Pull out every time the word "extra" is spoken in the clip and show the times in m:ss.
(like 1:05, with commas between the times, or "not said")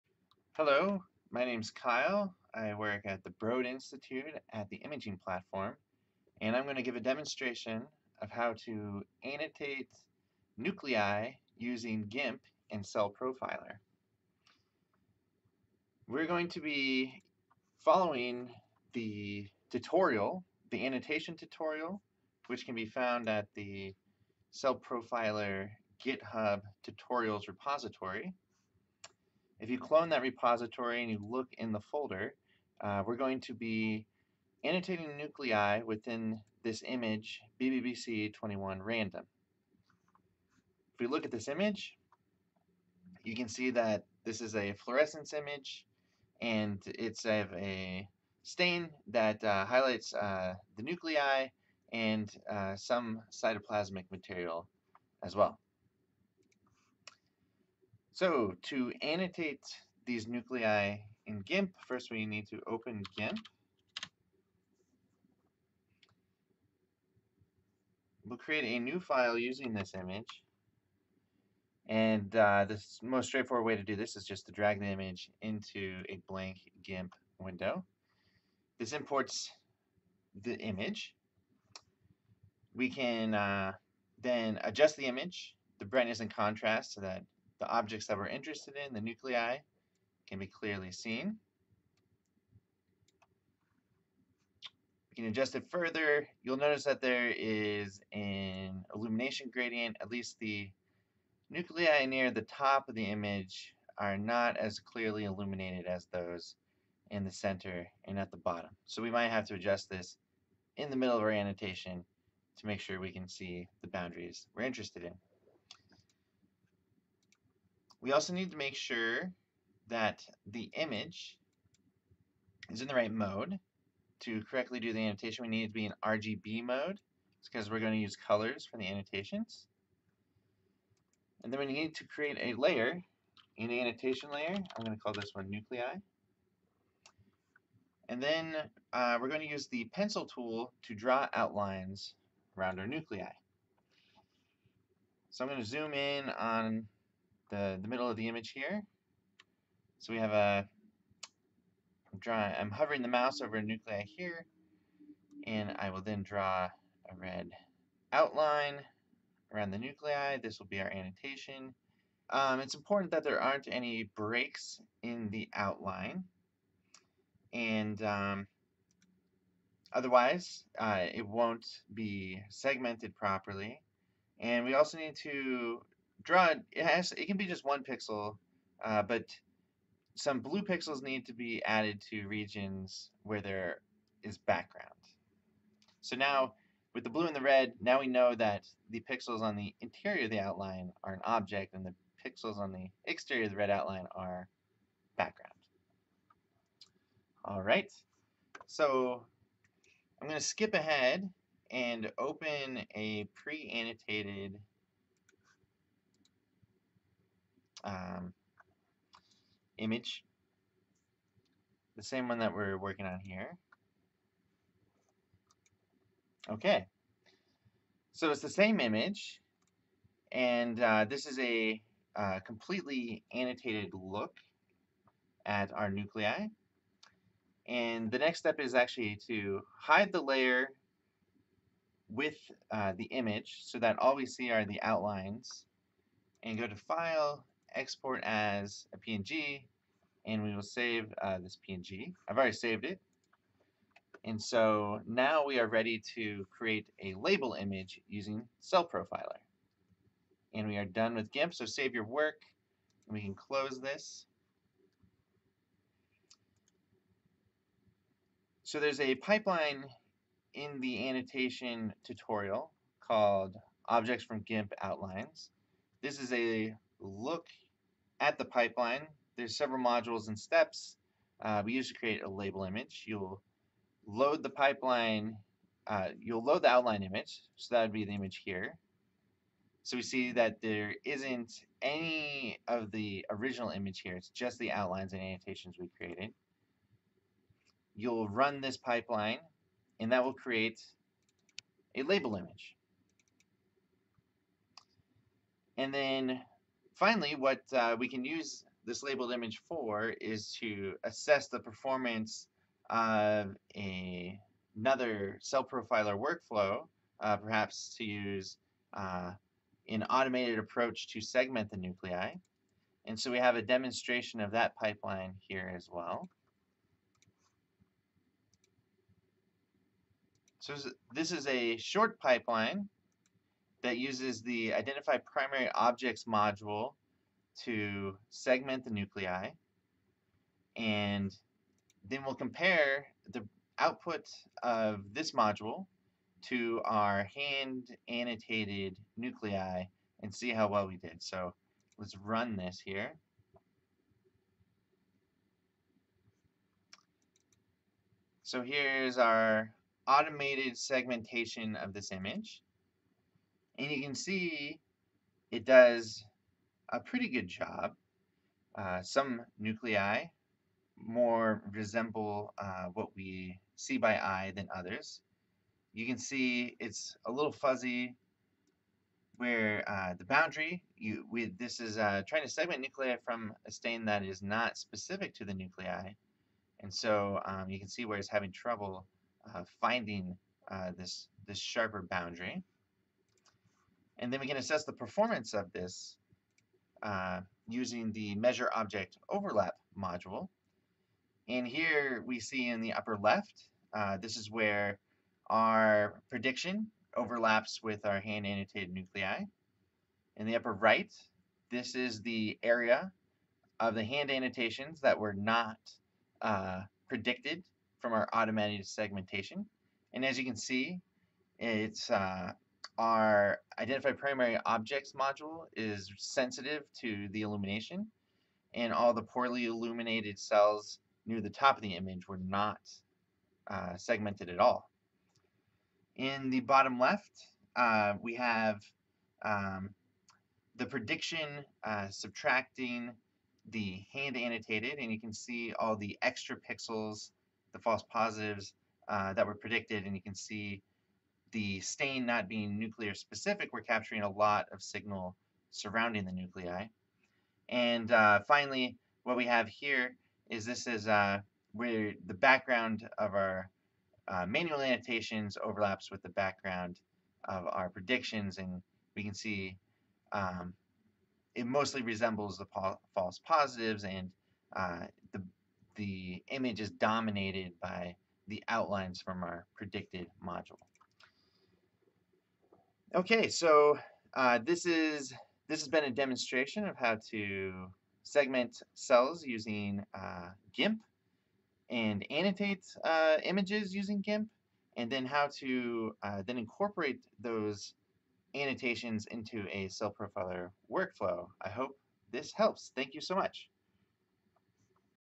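7:16.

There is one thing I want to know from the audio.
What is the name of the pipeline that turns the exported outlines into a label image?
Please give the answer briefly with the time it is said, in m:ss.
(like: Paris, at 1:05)
Objects from GIMP Outlines, at 4:23.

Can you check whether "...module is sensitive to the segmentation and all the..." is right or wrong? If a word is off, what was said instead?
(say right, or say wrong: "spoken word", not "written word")
wrong: "illumination", not "segmentation".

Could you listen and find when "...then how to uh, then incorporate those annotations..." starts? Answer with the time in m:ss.
8:05.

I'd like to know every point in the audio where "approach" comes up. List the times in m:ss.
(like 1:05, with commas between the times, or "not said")
5:10.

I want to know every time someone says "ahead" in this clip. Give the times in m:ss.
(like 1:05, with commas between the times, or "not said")
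3:20.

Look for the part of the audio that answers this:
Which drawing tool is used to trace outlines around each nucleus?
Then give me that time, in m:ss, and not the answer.
2:19.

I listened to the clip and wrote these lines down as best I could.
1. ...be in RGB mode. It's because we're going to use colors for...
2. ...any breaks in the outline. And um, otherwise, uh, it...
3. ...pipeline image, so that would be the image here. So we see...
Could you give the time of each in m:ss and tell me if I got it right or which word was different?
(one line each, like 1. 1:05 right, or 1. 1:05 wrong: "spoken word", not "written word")
1. 2:05 right
2. 2:43 right
3. 4:36 wrong: "outline", not "pipeline".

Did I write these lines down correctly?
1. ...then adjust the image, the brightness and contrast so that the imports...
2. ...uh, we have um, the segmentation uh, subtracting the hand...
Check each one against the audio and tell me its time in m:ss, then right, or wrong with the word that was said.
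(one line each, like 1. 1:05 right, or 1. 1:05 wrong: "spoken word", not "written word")
1. 1:24 wrong: "objects", not "imports"
2. 7:07 wrong: "prediction", not "segmentation".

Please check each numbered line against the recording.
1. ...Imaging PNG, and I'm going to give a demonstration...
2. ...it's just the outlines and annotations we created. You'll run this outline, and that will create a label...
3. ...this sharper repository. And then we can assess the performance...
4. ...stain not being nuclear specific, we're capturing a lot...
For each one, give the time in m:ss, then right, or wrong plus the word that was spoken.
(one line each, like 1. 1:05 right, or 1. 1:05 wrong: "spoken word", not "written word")
1. 0:04 wrong: "Platform", not "PNG"
2. 4:44 wrong: "pipeline", not "outline"
3. 6:21 wrong: "boundary", not "repository"
4. 7:21 right.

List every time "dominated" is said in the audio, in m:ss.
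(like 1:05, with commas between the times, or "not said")
7:46.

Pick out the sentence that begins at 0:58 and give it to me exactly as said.
So to annotate these nuclei in GIMP, first we need to open GIMP.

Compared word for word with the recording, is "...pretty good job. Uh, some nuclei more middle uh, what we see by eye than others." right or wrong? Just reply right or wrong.
wrong.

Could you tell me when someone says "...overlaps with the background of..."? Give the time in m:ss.
7:35.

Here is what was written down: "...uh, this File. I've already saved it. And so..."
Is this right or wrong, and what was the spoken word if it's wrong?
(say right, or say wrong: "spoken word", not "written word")
wrong: "PNG", not "File".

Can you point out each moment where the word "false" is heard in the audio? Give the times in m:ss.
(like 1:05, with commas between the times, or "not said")
7:17, 7:43.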